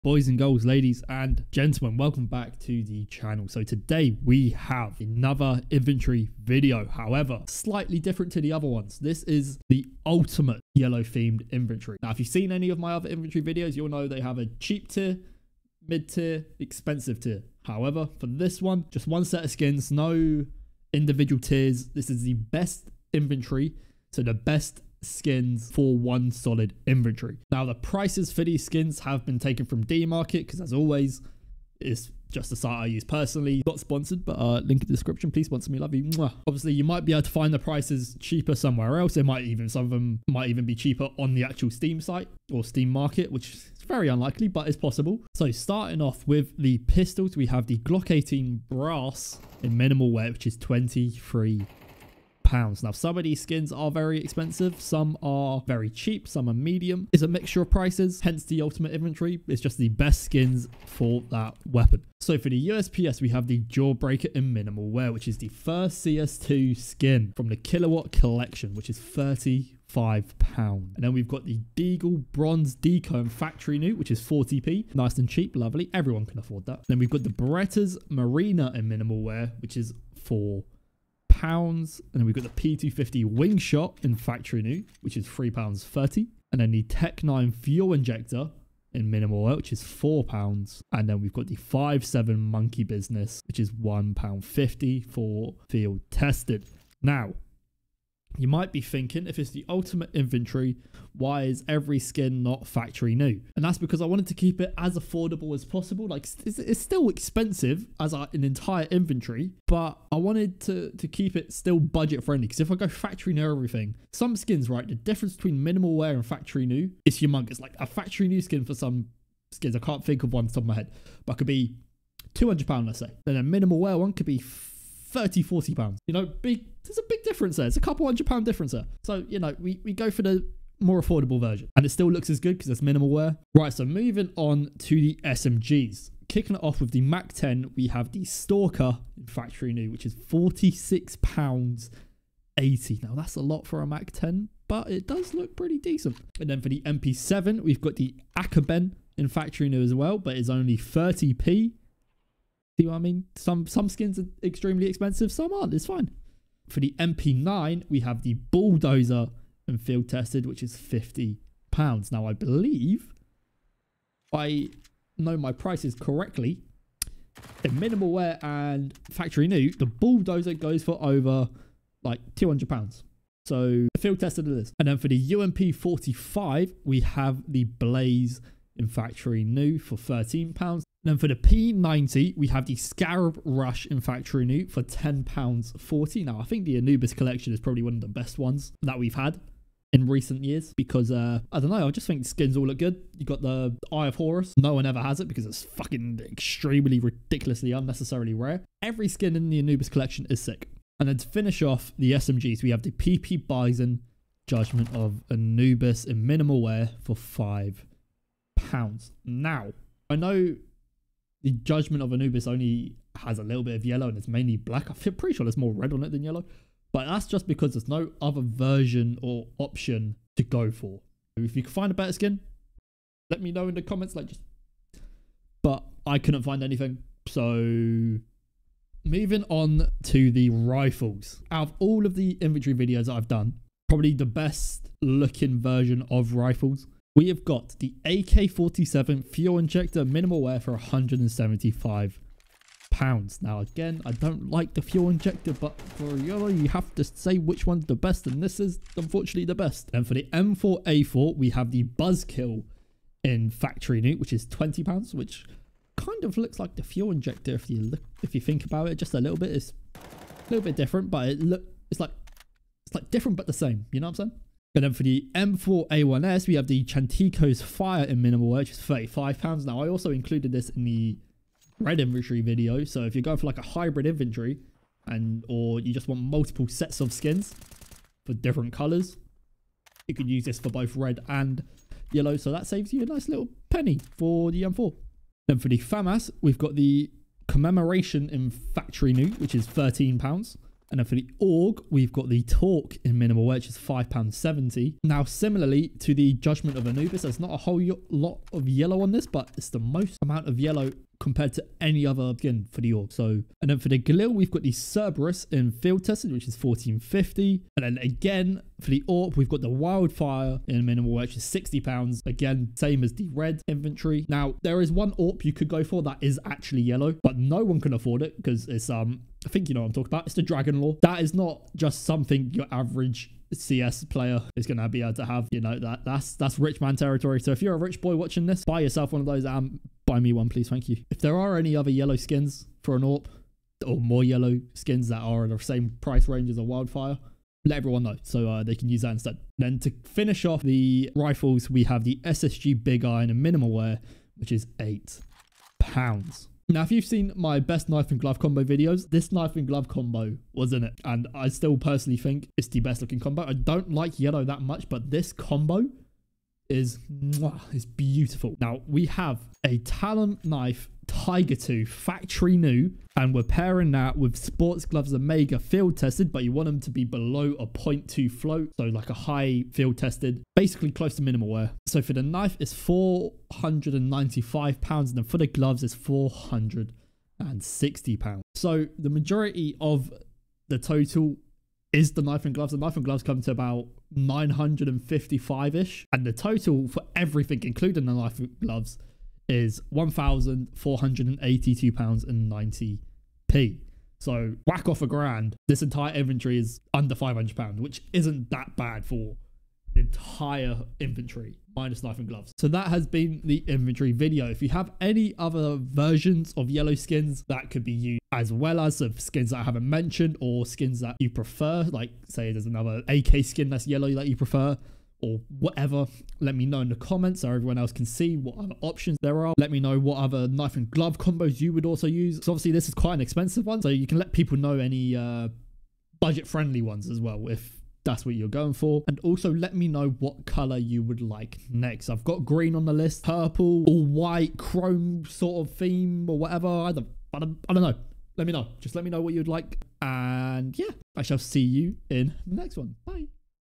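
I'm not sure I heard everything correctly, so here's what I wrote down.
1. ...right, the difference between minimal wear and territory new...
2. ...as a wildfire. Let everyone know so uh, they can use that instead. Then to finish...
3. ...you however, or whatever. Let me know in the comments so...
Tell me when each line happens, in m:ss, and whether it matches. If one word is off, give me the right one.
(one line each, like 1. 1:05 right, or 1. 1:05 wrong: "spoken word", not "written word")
1. 1:54 wrong: "factory", not "territory"
2. 5:36 right
3. 6:54 wrong: "prefer", not "however".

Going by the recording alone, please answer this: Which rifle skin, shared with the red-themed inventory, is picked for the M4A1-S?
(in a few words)
Chantico's Fire.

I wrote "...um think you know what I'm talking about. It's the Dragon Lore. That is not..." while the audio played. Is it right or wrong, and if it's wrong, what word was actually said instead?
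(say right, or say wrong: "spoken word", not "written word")
right.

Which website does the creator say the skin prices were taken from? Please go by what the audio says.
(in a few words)
DMarket.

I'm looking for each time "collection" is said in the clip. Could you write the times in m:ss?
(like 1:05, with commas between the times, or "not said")
1:08, 3:07, 3:19.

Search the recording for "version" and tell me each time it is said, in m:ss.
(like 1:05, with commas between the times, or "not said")
2:11, 3:38, 3:55, 6:45.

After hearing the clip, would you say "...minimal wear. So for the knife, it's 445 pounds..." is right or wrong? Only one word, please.
wrong.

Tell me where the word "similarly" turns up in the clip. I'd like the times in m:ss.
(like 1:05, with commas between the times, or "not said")
4:55.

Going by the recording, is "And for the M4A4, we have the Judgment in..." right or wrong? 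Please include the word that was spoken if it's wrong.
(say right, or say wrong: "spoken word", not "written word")
wrong: "Buzzkill", not "Judgment".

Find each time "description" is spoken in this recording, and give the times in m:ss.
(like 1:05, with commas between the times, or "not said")
0:34.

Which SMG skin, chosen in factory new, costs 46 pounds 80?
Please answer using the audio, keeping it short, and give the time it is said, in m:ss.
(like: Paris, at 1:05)
Stalker, at 2:18.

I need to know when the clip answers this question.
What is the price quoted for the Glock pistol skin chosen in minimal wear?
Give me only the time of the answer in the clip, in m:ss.
0:50.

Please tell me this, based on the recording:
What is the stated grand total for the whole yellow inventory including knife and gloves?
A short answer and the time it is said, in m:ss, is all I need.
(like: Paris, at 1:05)
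£1,482.90, at 6:29.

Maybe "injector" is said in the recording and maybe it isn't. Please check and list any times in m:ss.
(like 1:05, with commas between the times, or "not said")
1:27, 3:59, 4:05, 4:17.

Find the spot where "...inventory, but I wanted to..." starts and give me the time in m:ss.
1:48.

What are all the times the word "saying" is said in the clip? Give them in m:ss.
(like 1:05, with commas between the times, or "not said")
4:24.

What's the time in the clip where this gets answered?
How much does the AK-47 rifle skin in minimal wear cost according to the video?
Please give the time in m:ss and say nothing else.
4:00.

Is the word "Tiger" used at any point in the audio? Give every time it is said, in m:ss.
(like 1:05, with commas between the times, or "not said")
6:01.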